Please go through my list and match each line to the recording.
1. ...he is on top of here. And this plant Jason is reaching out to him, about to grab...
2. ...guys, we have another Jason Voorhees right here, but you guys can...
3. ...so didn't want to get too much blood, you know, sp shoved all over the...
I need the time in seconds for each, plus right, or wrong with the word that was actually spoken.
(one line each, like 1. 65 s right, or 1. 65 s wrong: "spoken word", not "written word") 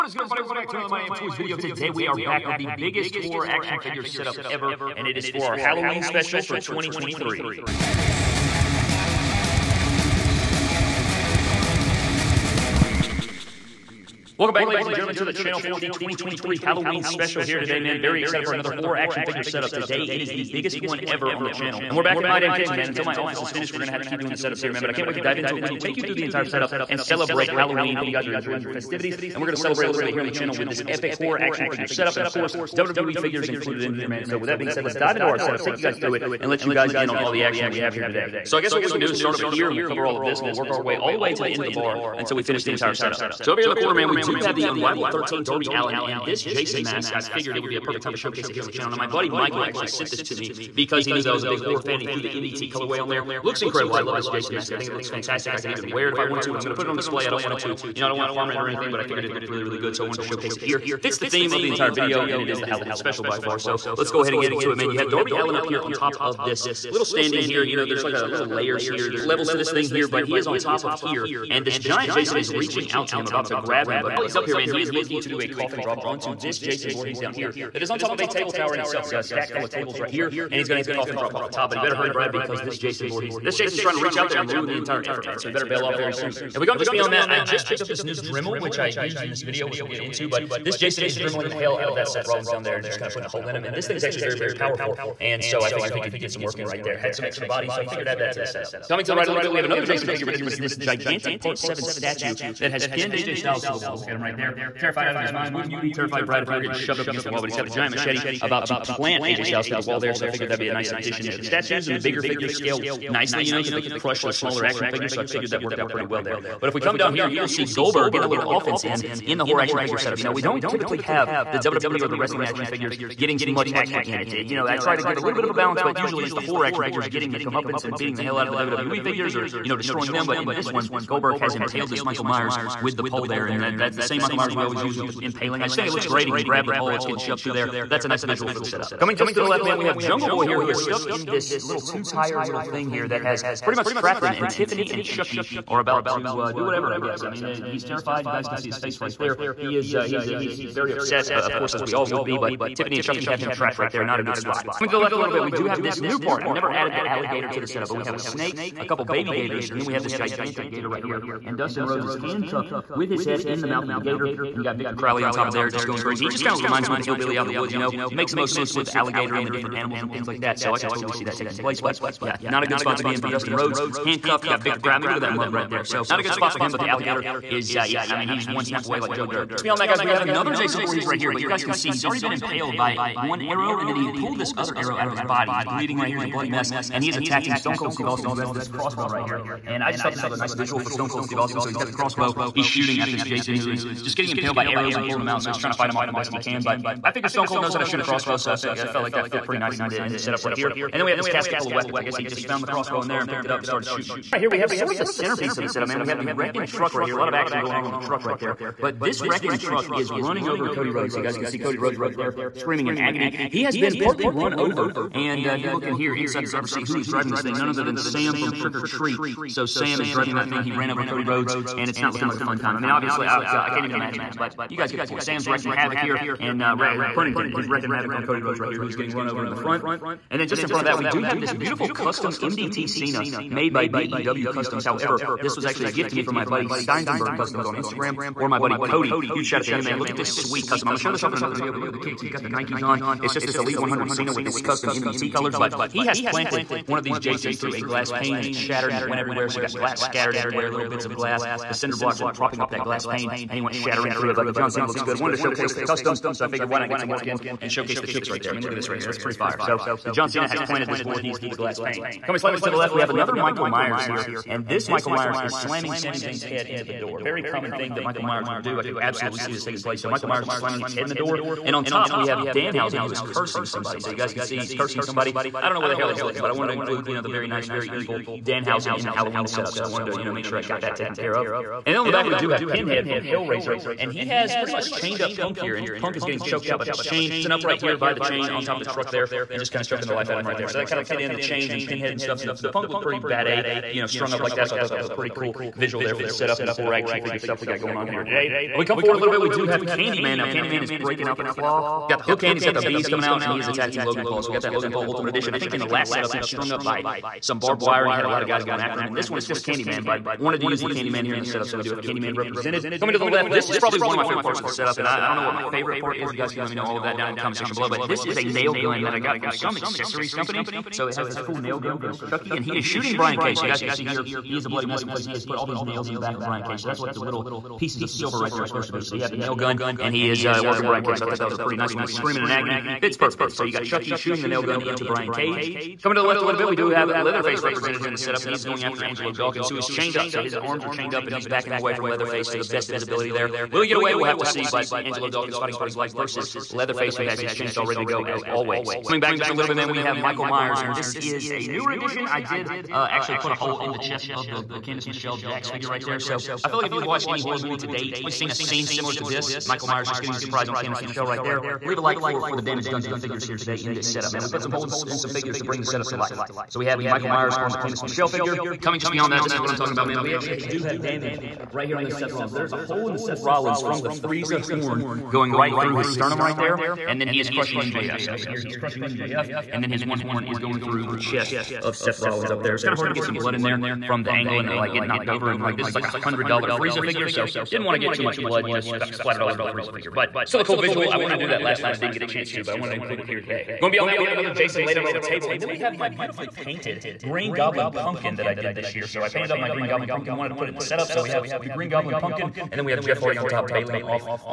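1. 70 s wrong: "giant", not "plant"
2. 179 s right
3. 387 s wrong: "splattered", not "shoved".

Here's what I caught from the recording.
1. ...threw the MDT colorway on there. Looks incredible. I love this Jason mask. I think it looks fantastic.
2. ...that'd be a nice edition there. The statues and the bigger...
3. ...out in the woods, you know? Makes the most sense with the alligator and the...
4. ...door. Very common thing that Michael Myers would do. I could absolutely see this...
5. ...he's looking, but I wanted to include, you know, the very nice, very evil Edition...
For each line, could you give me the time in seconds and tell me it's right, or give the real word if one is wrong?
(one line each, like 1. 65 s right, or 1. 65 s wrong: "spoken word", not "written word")
1. 52 s right
2. 110 s wrong: "addition", not "edition"
3. 167 s right
4. 266 s right
5. 276 s wrong: "Danhausen", not "Edition".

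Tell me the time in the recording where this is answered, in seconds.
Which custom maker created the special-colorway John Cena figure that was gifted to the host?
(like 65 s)
233 s.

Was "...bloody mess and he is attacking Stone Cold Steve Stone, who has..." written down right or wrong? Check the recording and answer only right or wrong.
wrong.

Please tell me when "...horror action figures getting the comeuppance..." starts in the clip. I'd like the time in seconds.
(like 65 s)
126 s.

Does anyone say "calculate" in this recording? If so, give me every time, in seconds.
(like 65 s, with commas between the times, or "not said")
not said.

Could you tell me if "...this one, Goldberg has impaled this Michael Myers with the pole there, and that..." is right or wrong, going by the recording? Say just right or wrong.
right.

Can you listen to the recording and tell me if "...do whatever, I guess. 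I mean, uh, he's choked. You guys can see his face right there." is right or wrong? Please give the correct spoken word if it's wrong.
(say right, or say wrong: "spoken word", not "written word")
wrong: "terrified", not "choked".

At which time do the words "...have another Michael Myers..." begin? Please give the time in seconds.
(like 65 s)
262 s.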